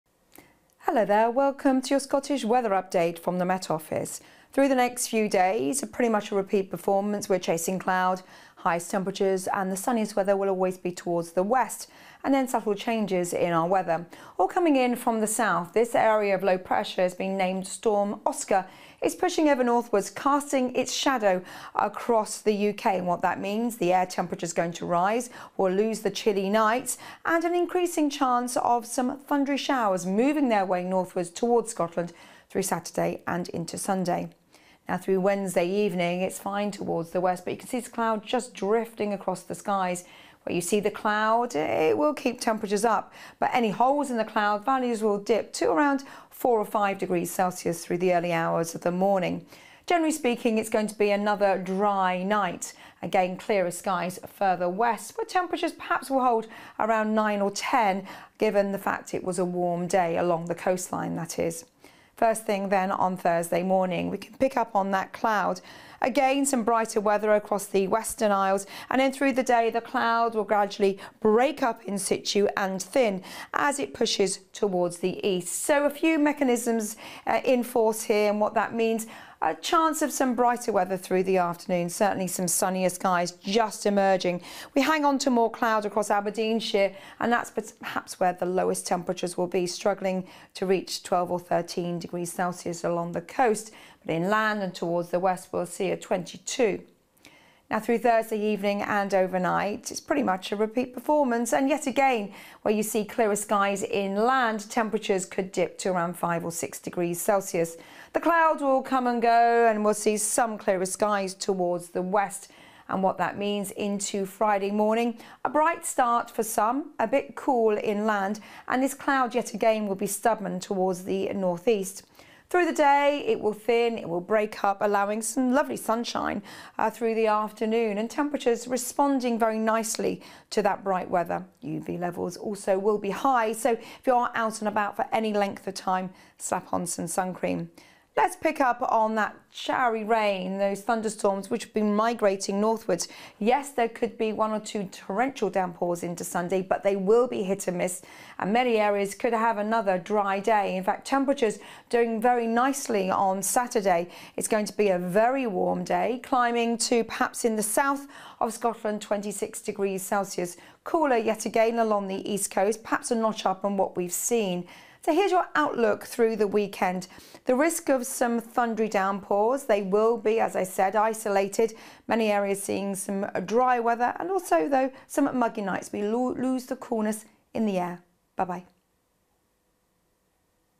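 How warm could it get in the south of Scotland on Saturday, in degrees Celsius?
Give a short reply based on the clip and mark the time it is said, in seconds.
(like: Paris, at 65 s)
26, at 159 s.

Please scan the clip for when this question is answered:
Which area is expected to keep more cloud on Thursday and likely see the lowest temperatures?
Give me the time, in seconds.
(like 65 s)
86 s.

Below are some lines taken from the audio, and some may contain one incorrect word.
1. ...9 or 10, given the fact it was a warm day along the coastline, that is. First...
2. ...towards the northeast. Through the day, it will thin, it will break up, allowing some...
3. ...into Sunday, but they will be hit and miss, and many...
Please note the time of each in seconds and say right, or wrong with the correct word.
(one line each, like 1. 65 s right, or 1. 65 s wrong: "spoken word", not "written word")
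1. 57 s right
2. 120 s right
3. 146 s right.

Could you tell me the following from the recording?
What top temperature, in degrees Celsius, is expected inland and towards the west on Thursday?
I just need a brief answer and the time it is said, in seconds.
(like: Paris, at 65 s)
22, at 95 s.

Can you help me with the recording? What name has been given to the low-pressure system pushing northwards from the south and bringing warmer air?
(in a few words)
Storm Oscar.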